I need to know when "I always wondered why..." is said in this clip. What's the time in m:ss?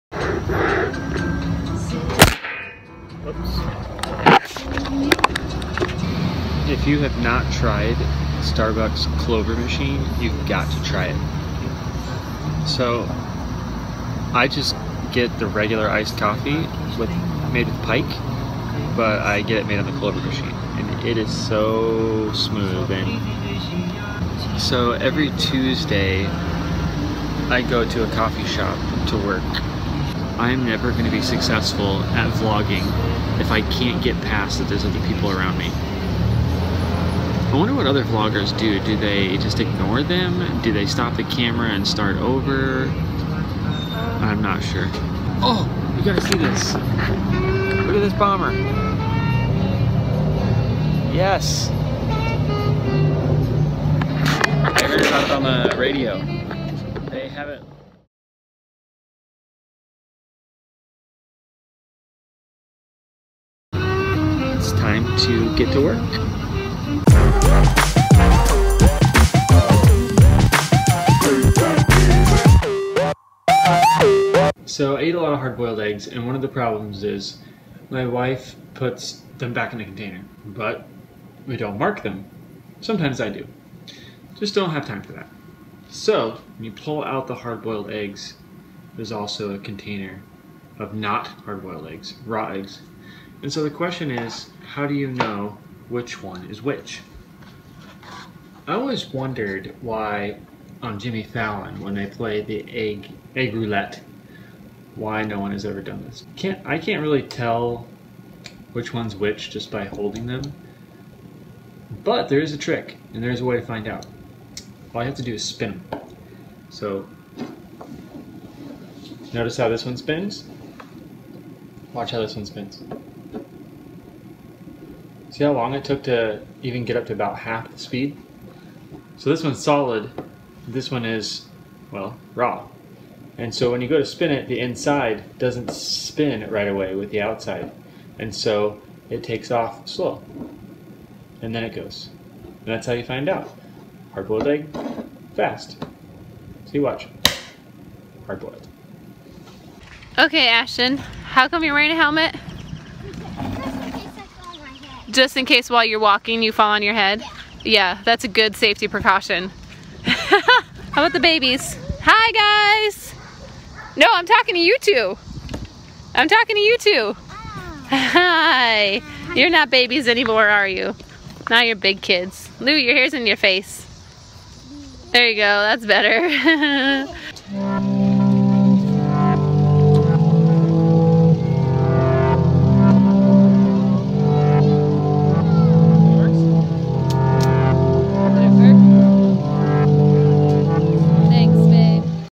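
1:38.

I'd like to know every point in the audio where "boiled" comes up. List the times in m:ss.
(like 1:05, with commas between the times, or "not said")
1:15, 1:27, 1:31, 2:24, 2:28.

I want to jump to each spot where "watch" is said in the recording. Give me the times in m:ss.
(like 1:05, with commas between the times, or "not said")
2:01, 2:26.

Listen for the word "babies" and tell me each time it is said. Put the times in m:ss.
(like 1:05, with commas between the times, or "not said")
2:41, 2:49.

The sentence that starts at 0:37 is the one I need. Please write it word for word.
I wonder what other vloggers do.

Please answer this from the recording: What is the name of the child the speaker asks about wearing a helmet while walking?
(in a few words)
Ashton.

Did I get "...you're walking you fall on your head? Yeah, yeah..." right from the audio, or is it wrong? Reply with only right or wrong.
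right.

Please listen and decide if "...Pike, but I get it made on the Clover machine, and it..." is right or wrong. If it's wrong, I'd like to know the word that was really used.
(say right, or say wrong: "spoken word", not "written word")
right.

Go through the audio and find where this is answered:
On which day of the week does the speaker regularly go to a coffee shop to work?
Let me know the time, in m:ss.
0:25.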